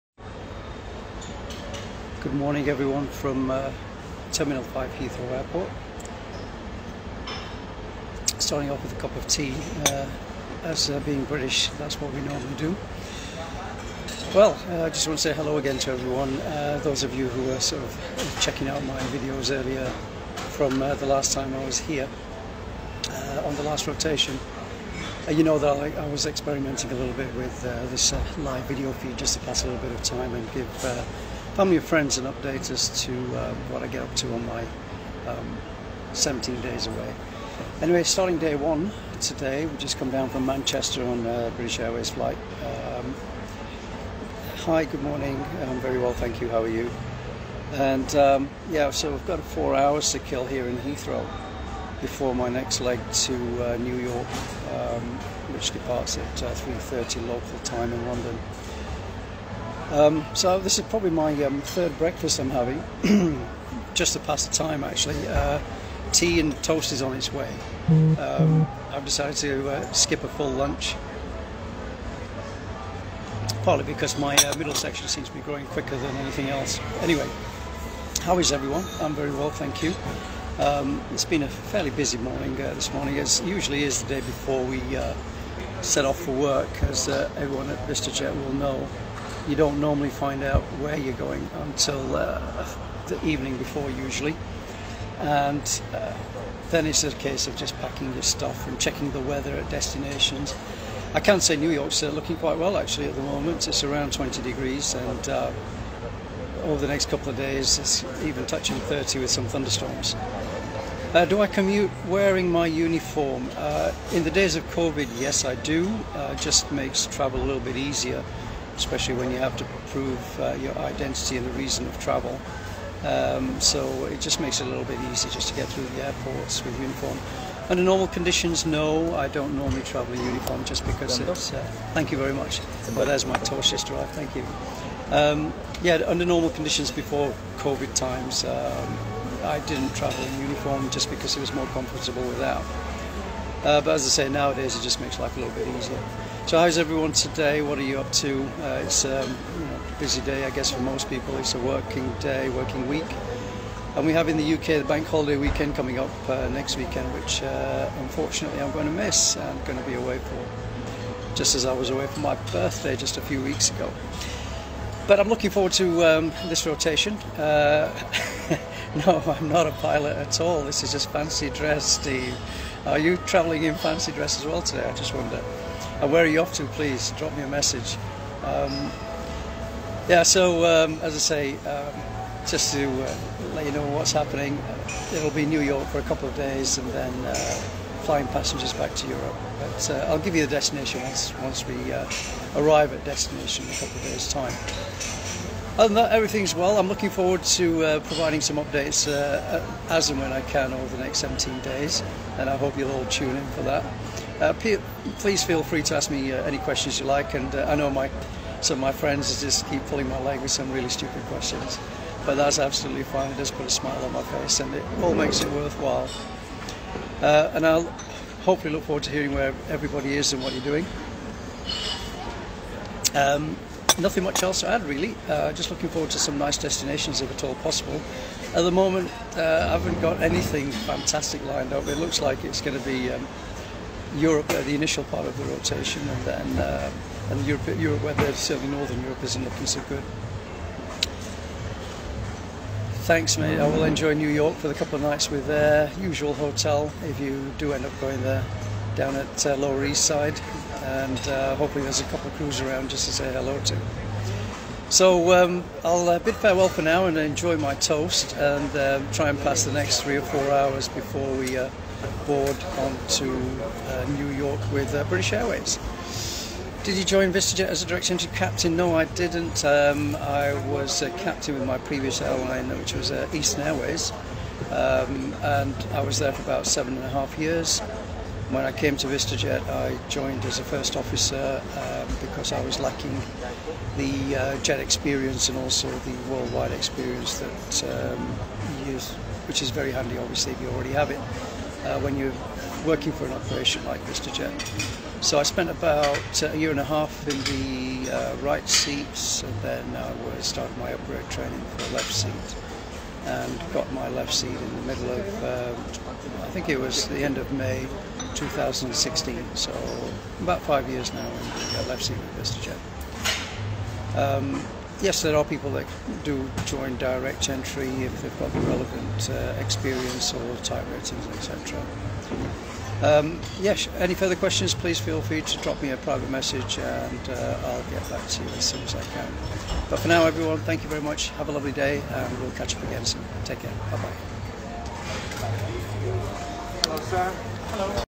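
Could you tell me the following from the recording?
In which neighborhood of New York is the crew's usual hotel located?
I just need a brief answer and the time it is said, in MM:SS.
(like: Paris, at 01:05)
Lower East Side, at 04:09.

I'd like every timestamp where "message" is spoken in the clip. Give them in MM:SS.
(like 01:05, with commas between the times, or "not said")
02:57, 05:26.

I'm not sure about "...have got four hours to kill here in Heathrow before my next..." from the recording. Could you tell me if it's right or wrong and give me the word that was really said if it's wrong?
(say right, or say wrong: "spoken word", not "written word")
right.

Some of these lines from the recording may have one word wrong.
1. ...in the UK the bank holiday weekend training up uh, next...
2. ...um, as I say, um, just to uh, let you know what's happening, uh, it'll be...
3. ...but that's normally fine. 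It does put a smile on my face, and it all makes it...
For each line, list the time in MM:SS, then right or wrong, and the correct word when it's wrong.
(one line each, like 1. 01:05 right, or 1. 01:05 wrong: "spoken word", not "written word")
1. 02:34 wrong: "coming", not "training"
2. 03:00 right
3. 03:32 wrong: "absolutely", not "normally".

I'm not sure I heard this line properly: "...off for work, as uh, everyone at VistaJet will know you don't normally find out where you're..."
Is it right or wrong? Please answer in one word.
right.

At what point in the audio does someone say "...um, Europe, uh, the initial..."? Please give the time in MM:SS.
03:53.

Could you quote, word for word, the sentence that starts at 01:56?
Uh, just makes travel a little bit easier especially when you have to prove uh, your identity and the reason of travel.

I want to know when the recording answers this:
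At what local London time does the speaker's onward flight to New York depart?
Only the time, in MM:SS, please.
00:56.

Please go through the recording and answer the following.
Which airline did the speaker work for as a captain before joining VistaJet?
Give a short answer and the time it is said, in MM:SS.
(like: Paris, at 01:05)
Eastern Airways, at 04:33.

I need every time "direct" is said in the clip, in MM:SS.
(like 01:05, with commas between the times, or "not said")
04:27, 05:16.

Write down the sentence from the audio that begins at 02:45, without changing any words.
But I'm looking forward to um, this rotation.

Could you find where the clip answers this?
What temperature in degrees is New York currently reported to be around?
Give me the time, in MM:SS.
01:44.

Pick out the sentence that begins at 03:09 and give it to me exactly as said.
But uh, I'll give you the destination once, once we uh, arrive at destination in a couple of days' time.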